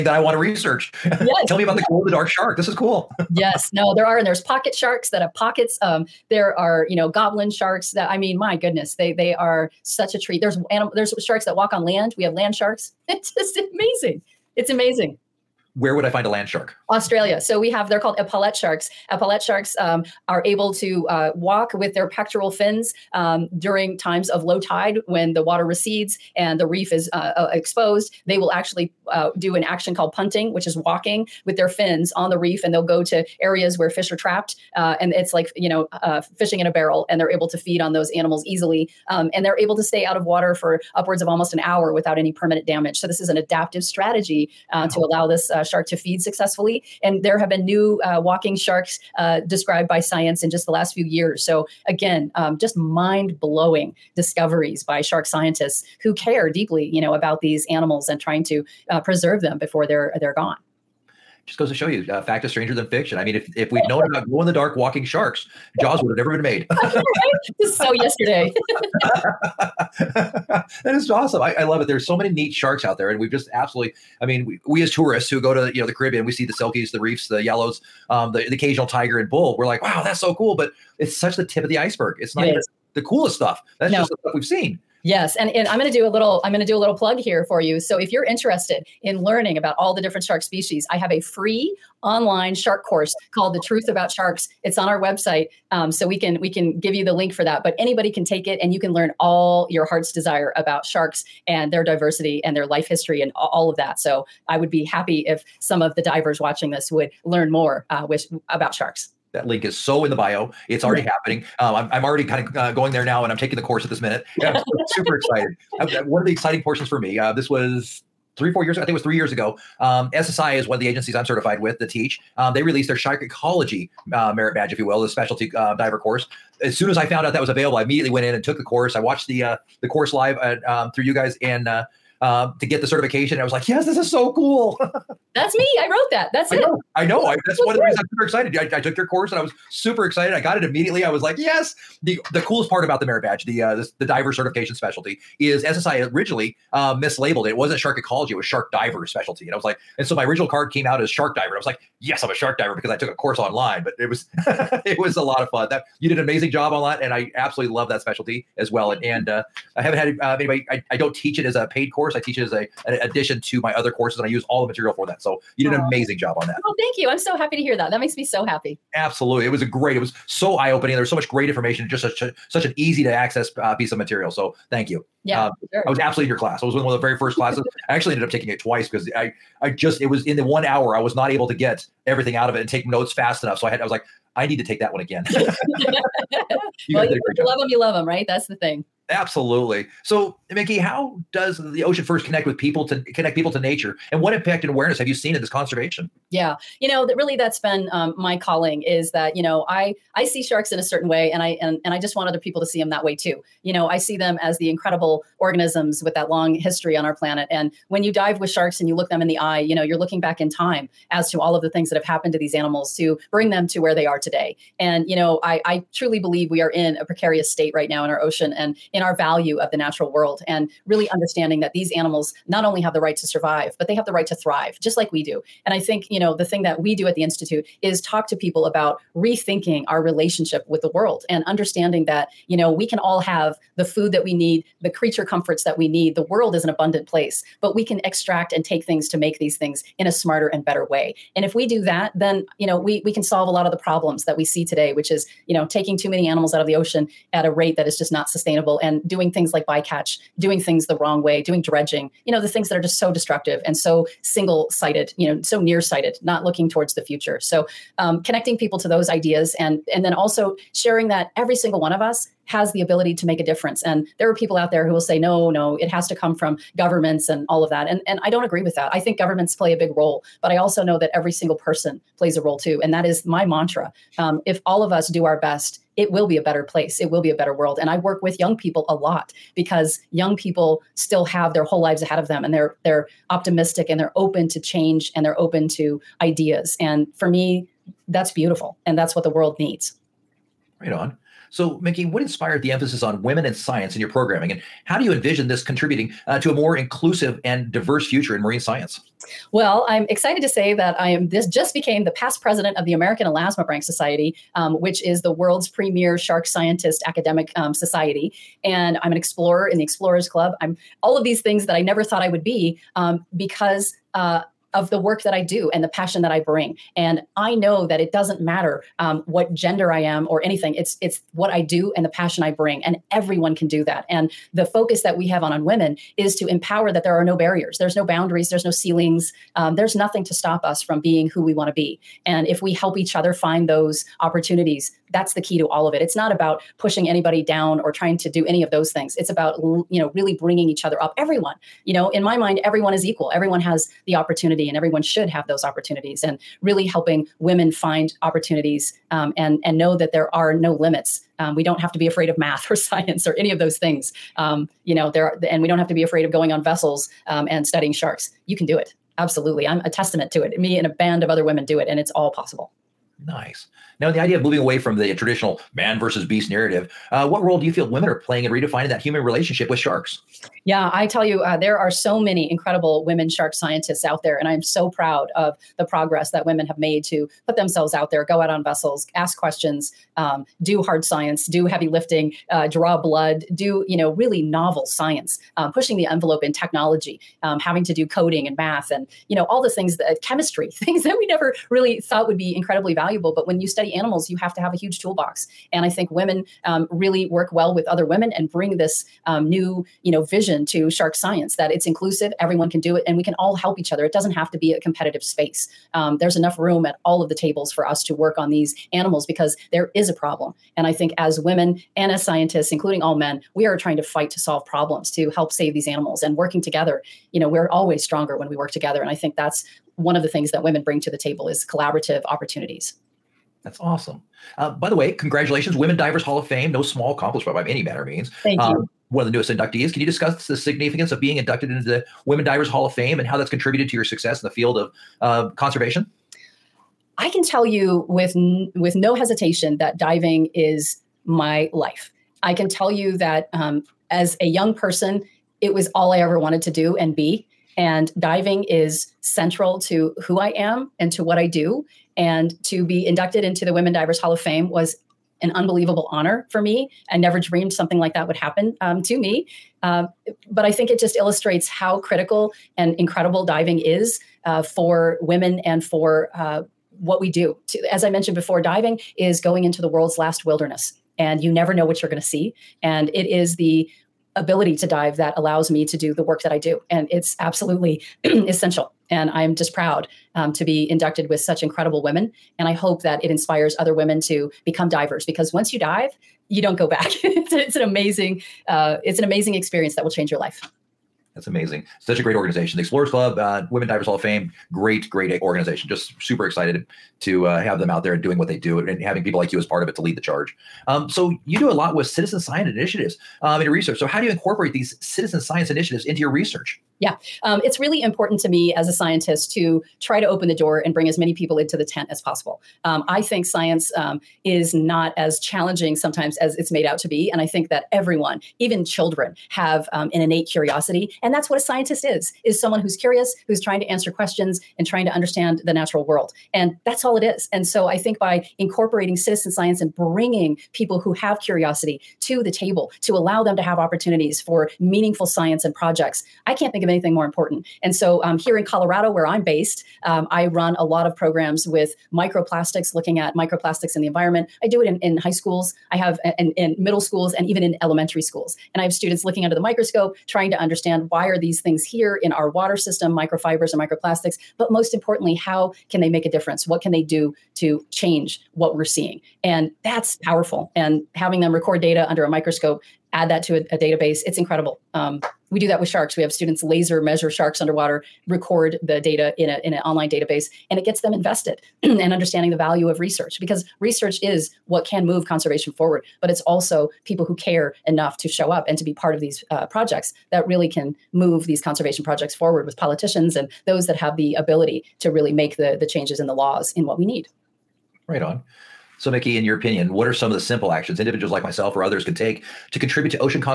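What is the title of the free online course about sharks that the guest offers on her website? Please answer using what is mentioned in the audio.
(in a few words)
The Truth About Sharks.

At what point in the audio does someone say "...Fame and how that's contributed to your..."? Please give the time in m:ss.
7:12.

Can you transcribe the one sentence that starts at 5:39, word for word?
It's about, you know, really bringing each other up.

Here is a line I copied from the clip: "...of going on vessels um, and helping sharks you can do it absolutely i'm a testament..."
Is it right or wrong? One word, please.
wrong.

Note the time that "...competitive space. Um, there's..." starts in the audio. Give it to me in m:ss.
6:44.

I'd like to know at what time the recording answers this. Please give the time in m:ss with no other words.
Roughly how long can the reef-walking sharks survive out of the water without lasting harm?
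0:41.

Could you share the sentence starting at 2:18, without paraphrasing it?
I, I took your course and I was super excited.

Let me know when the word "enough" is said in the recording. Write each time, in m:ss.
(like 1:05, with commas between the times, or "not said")
3:03, 6:46, 9:37.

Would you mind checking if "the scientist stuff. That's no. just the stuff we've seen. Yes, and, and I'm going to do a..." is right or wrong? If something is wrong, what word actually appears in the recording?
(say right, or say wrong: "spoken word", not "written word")
wrong: "coolest", not "scientist".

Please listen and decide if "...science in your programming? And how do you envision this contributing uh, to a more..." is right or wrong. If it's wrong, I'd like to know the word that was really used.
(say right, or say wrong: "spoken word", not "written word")
right.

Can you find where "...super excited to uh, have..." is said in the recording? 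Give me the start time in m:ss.
8:16.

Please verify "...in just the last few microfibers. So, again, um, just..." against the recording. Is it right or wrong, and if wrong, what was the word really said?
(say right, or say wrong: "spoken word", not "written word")
wrong: "years", not "microfibers".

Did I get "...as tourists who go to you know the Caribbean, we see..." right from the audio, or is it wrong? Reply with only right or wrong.
right.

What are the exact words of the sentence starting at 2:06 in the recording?
As soon as I found out that was available, I immediately went in and took the course.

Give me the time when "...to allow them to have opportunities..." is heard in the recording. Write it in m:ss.
8:53.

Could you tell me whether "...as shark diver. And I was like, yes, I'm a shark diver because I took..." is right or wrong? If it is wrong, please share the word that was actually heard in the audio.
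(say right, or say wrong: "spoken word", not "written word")
right.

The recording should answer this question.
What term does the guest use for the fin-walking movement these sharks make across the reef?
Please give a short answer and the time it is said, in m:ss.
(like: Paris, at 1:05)
Punting, at 0:30.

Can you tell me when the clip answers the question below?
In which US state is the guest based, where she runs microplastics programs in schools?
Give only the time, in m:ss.
8:58.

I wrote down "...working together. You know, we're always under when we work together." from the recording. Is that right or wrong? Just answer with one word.
wrong.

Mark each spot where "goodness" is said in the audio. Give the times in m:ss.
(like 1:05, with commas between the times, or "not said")
0:08.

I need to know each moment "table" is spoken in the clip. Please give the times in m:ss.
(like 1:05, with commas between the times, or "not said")
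6:47, 7:01, 8:52.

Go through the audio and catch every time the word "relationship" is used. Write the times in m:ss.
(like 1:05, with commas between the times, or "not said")
3:50, 6:09.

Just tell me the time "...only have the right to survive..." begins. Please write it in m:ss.
3:42.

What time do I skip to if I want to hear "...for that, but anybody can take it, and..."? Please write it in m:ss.
1:37.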